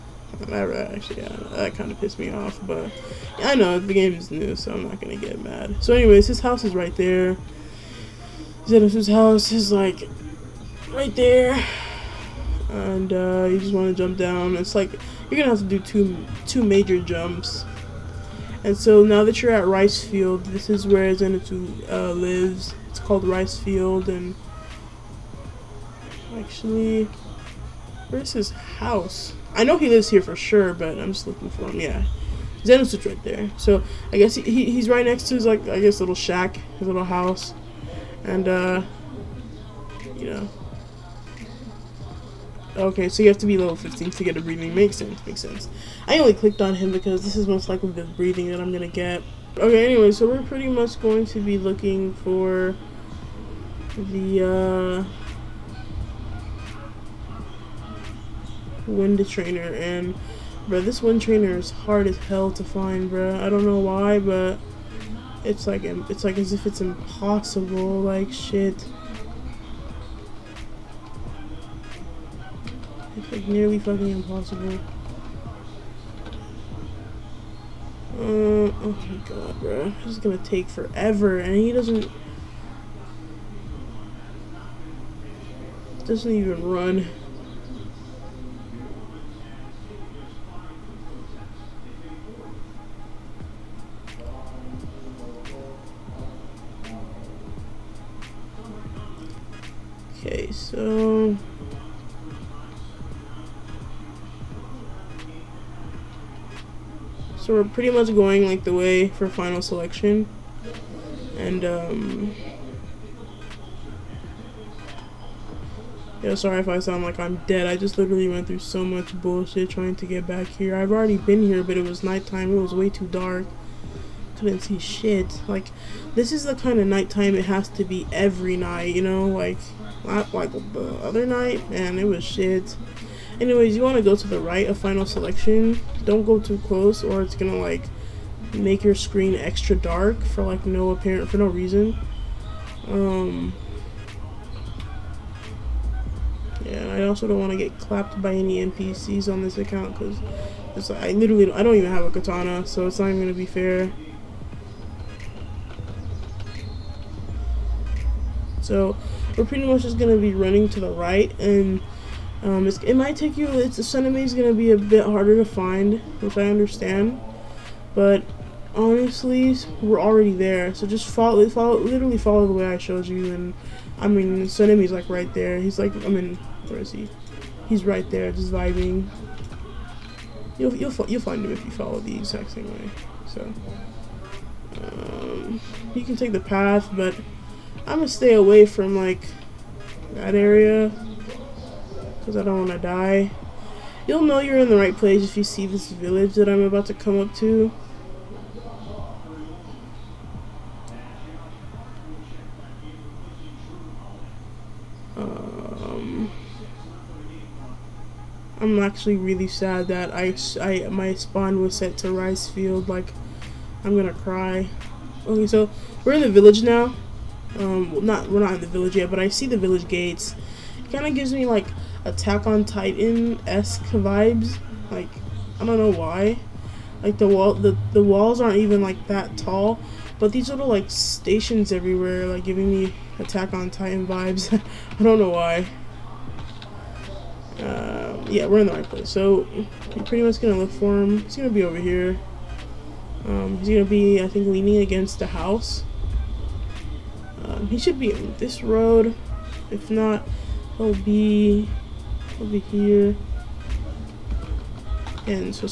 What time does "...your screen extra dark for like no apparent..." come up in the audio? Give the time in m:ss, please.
2:18.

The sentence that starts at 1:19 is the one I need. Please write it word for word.
This is gonna take forever, and he doesn't...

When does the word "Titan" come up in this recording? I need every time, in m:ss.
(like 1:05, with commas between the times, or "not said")
3:42, 3:53.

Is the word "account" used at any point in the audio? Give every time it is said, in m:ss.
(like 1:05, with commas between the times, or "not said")
2:29.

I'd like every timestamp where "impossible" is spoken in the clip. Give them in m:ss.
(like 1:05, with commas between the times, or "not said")
1:06, 1:14.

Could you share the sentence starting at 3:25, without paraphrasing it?
Um, I'm actually really sad that I, I my spawn was set to rice field.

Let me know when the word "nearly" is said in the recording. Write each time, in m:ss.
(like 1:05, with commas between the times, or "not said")
1:13.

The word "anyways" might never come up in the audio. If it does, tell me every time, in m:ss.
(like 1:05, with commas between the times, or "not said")
0:05, 0:49, 2:13.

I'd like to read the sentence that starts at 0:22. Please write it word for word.
It's called Rice Field, and actually, where's his house?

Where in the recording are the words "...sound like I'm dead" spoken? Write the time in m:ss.
1:56.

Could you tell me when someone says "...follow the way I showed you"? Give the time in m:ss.
2:52.